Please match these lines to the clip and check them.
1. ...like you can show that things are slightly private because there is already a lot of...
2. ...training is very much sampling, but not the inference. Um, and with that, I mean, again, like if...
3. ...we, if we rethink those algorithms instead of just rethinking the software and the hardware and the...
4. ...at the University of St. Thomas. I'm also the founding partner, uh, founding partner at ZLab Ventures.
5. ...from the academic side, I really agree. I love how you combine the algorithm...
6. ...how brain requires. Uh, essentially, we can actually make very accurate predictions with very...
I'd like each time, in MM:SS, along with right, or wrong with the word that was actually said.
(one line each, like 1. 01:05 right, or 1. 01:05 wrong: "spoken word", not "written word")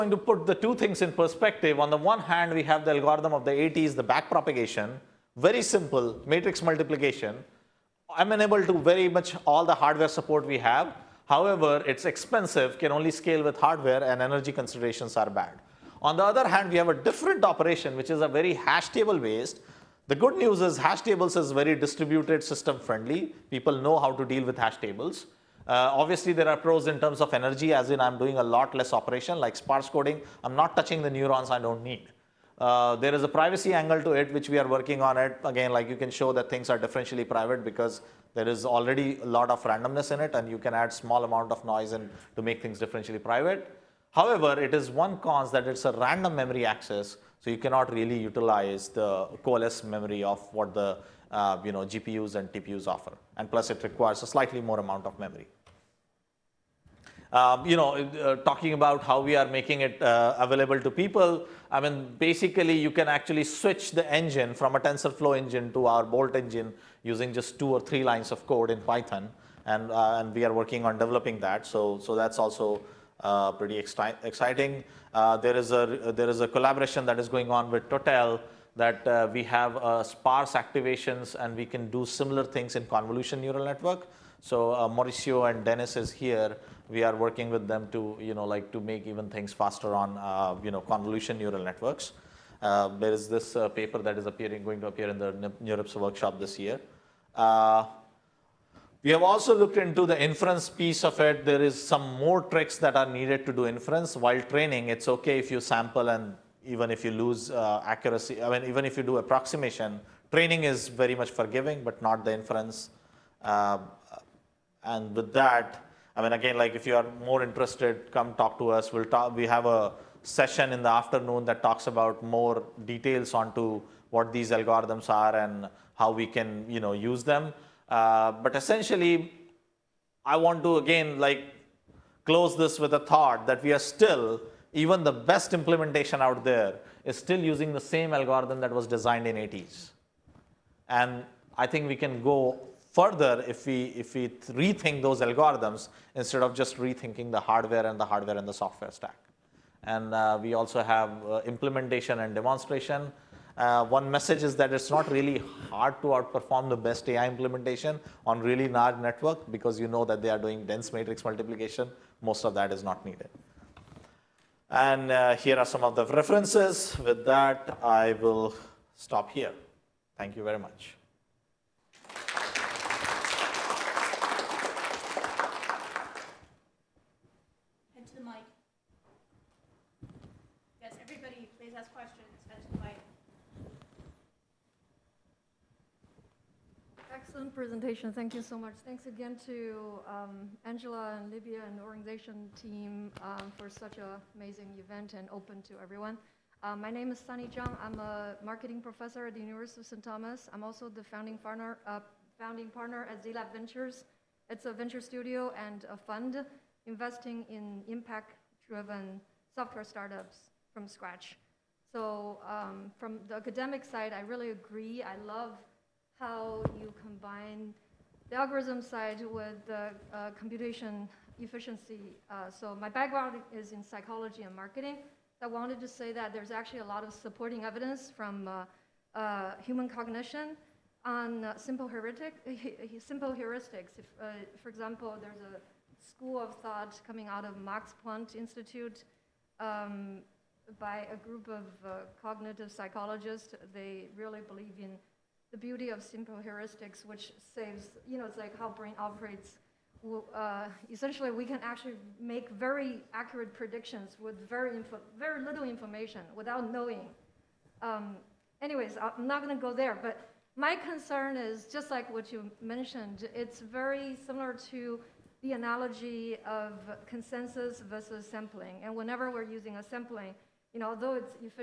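1. 00:35 wrong: "differentially", not "slightly"
2. 01:50 wrong: "forgiving", not "sampling"
3. 02:23 wrong: "hardware", not "software"
4. 03:19 right
5. 03:32 right
6. 04:08 wrong: "operates", not "requires".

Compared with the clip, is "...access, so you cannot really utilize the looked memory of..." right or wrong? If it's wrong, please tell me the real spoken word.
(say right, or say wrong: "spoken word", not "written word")
wrong: "coalesced", not "looked".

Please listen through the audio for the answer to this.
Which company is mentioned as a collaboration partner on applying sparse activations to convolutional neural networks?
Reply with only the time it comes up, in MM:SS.
01:17.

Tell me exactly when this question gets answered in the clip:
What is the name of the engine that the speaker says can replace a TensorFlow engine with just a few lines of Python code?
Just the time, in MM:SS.
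01:06.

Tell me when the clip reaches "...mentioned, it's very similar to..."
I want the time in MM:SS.
04:22.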